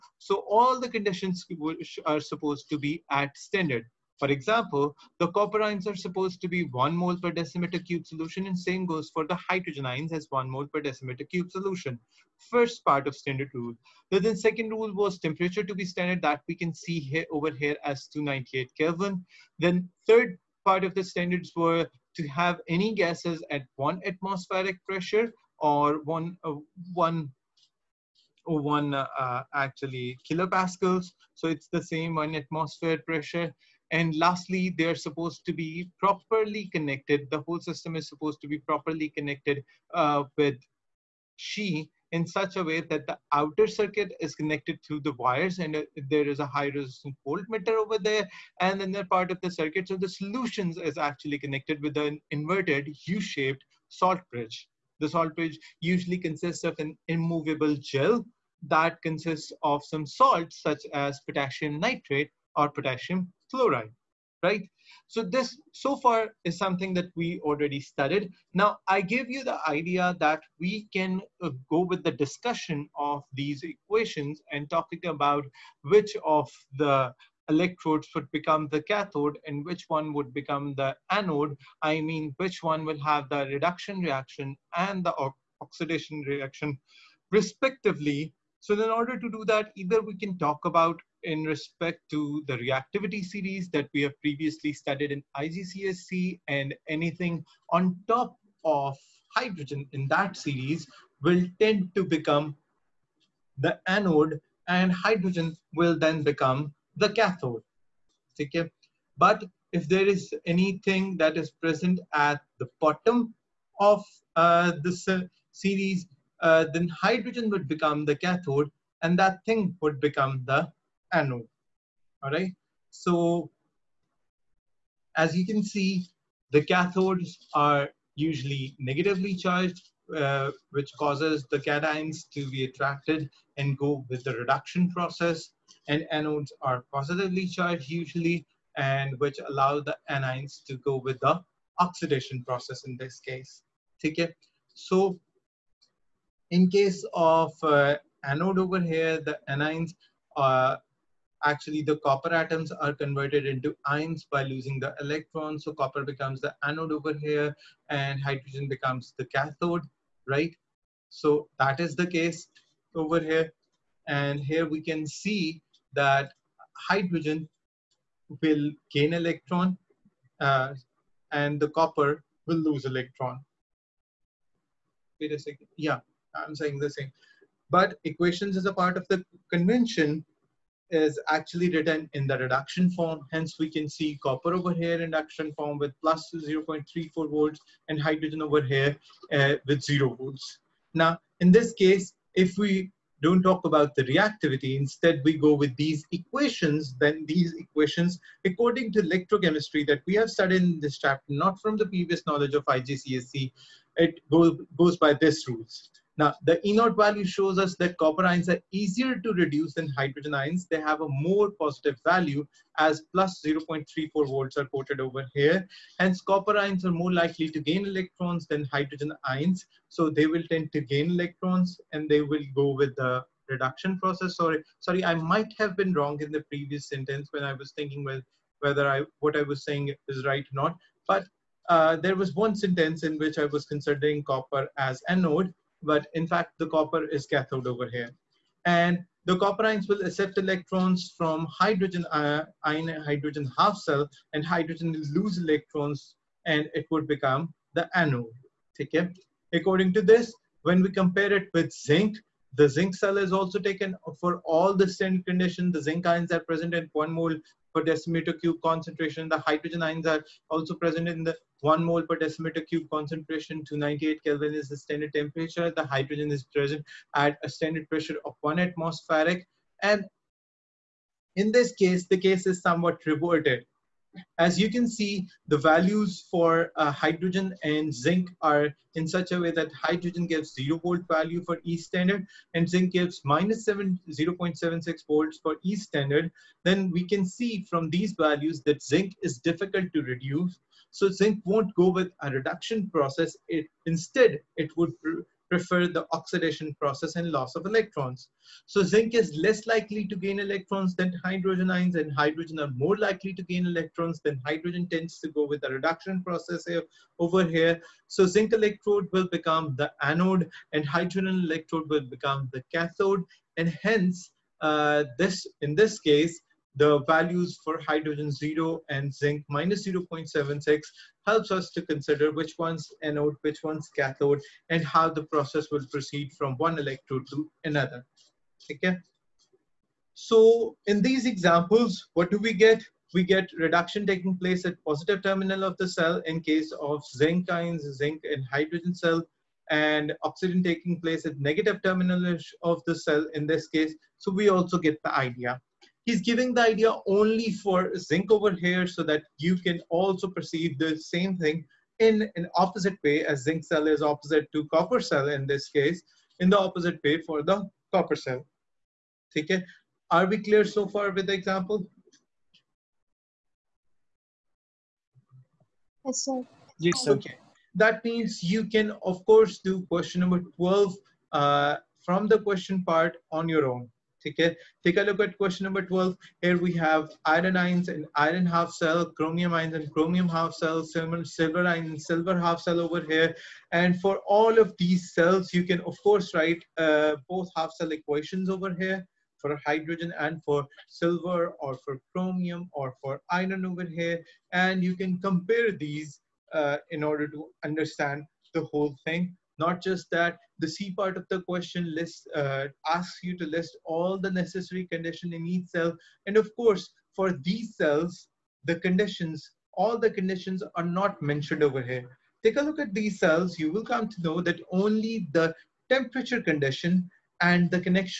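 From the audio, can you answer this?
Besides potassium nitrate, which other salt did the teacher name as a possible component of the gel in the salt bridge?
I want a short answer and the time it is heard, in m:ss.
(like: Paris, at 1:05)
potassium fluoride, at 1:02.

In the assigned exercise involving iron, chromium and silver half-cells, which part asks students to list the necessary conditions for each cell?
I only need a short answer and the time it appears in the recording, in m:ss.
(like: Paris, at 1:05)
C part, at 6:40.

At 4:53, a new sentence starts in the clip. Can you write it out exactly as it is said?
It, instead, it would prefer the oxidation process and loss of electrons.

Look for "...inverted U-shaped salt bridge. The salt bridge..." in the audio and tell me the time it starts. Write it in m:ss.
0:52.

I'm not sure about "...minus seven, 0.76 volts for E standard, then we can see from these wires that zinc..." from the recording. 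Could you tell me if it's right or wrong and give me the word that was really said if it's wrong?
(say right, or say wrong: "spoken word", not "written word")
wrong: "values", not "wires".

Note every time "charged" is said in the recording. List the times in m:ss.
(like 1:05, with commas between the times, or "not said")
2:09, 2:17.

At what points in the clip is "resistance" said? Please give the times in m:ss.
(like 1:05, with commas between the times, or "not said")
0:46.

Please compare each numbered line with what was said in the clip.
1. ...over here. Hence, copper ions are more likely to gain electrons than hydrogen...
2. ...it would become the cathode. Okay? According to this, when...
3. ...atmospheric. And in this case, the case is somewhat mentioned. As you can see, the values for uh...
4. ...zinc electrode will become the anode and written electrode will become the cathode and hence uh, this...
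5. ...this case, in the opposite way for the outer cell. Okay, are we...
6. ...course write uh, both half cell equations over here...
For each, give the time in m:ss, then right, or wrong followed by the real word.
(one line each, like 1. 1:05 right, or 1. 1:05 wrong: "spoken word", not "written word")
1. 3:35 right
2. 4:06 wrong: "anode", not "cathode"
3. 4:28 wrong: "reverted", not "mentioned"
4. 5:08 wrong: "hydrogen", not "written"
5. 5:55 wrong: "copper", not "outer"
6. 6:26 right.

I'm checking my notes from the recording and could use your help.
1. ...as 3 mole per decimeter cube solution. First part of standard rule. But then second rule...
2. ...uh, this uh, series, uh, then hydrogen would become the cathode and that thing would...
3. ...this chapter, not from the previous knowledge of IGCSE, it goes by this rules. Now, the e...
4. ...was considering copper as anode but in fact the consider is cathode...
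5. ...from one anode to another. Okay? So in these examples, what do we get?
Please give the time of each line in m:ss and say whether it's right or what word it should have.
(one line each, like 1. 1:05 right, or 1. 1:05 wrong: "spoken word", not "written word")
1. 0:10 wrong: "1", not "3"
2. 1:54 right
3. 3:20 right
4. 3:53 wrong: "copper", not "consider"
5. 5:26 wrong: "electrode", not "anode".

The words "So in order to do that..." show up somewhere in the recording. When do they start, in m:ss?
1:28.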